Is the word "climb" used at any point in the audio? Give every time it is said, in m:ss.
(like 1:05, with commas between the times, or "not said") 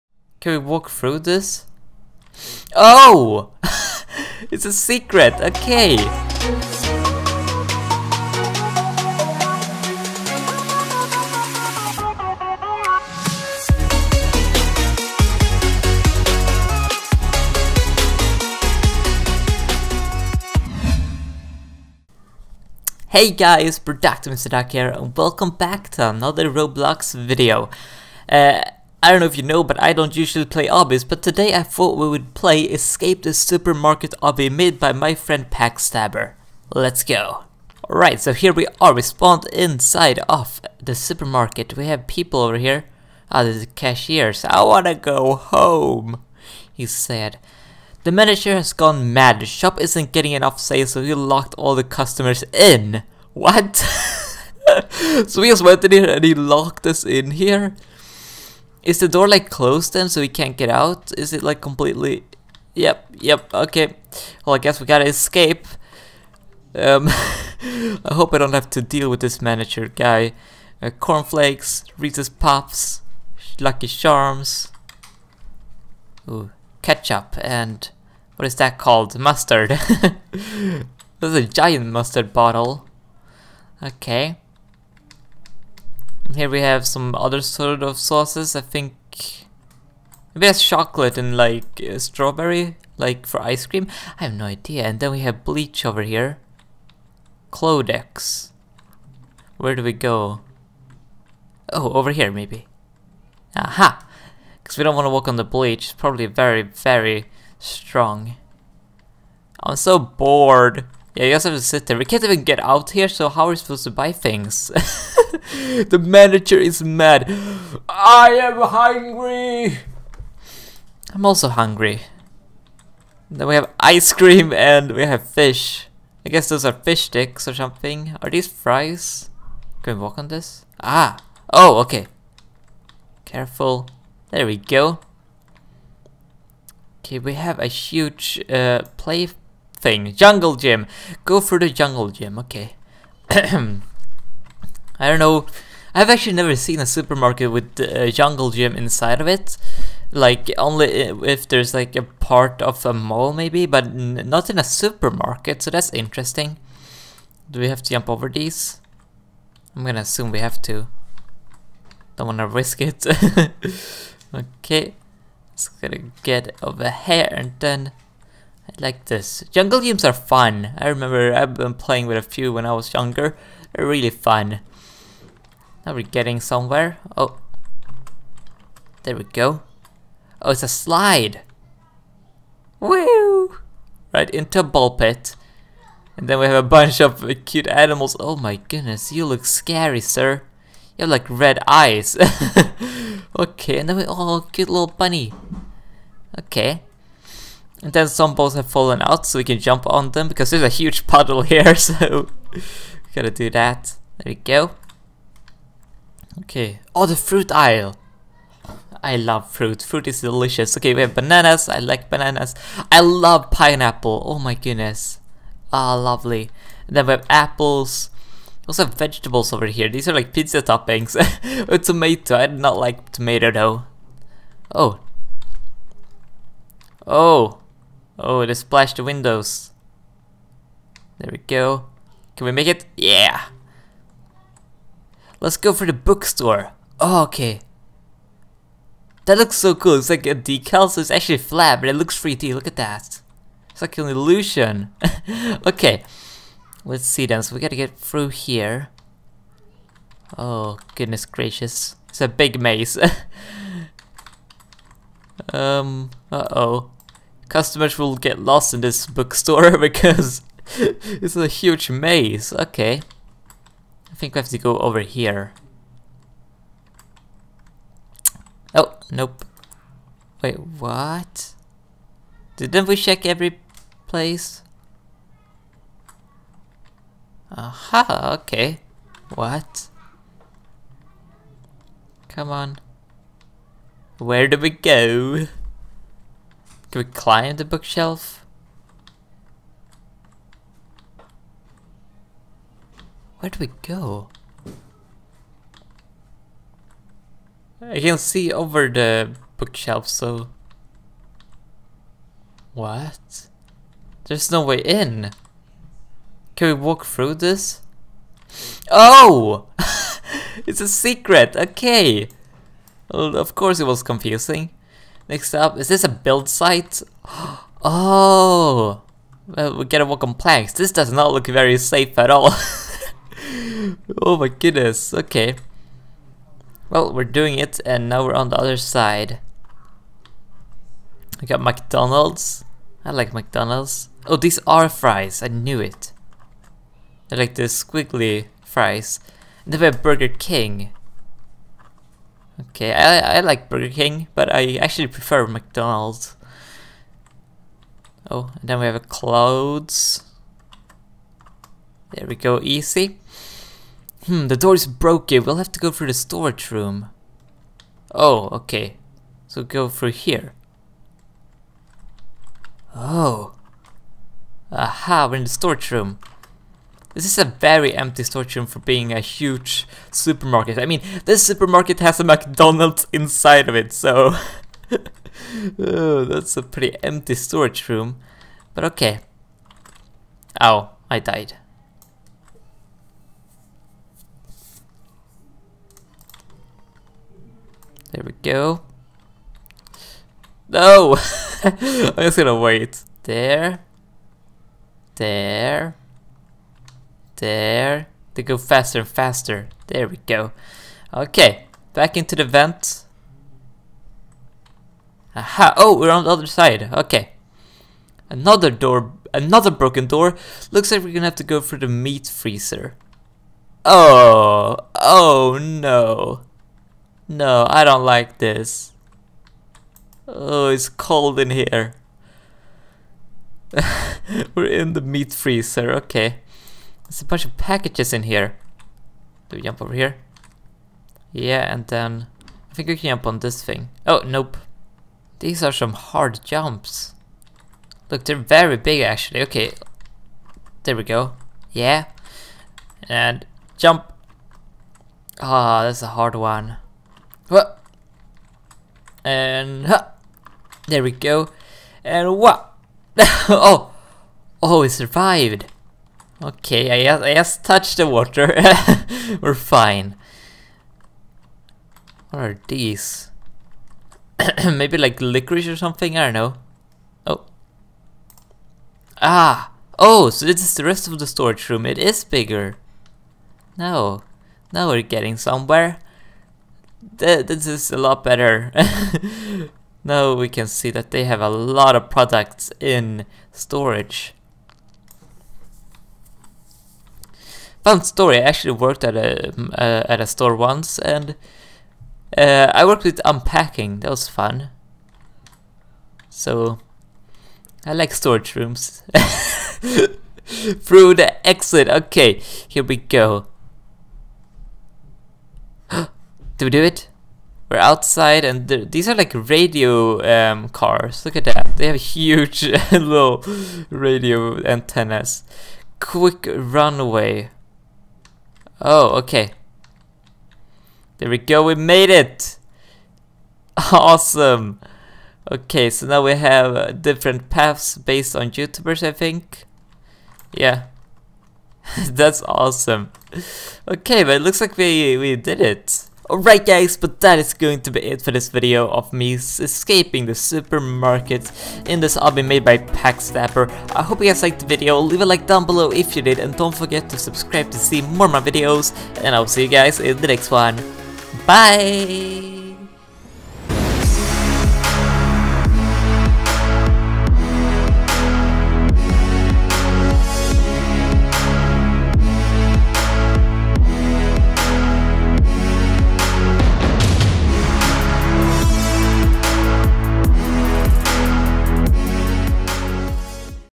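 4:47.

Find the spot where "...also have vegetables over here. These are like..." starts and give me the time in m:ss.
3:38.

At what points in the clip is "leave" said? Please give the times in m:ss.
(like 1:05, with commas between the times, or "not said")
9:04.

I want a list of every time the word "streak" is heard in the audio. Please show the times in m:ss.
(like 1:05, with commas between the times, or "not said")
not said.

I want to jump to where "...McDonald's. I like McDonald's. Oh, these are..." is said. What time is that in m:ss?
5:31.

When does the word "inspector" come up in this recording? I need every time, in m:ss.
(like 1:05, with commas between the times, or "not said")
not said.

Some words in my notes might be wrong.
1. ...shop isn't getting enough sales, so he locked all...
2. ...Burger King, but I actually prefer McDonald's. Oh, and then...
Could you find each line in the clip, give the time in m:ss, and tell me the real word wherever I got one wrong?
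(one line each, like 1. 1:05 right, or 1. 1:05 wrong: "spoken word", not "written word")
1. 0:49 right
2. 5:43 right.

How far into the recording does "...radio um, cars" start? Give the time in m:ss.
8:29.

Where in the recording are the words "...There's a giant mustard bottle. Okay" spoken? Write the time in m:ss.
1:21.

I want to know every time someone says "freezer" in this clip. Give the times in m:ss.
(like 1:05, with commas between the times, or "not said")
6:52, 7:05.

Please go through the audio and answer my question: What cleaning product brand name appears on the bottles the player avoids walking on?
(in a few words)
Clodex.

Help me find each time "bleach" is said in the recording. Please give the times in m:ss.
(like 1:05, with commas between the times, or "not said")
1:35, 1:45.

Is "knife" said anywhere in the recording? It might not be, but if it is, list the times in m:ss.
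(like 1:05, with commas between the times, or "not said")
not said.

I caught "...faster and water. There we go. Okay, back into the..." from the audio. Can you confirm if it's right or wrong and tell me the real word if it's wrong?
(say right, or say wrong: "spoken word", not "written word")
wrong: "faster", not "water".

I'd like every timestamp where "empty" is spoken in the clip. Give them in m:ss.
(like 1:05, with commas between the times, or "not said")
6:07, 6:17.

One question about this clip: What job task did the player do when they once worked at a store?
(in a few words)
Unpacking.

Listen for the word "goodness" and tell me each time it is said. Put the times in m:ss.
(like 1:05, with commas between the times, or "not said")
3:08, 3:34, 4:10, 5:24.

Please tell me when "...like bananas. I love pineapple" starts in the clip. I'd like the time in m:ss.
3:31.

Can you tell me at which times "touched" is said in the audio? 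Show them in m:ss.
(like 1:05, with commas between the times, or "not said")
7:37.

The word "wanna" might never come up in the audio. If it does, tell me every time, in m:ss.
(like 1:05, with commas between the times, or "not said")
0:44, 2:42.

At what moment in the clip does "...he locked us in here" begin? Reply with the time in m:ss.
0:56.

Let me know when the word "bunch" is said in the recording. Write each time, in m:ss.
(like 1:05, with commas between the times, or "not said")
3:06, 7:07.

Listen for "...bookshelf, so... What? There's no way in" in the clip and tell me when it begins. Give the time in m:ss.
4:59.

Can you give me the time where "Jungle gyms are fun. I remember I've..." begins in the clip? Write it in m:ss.
2:49.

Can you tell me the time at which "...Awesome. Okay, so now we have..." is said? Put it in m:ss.
8:43.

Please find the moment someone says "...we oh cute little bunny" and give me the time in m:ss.
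3:13.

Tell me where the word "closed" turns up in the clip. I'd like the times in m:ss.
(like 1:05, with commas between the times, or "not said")
0:59.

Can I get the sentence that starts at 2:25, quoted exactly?
I've actually never seen a supermarket with a uh, jungle gym inside of it.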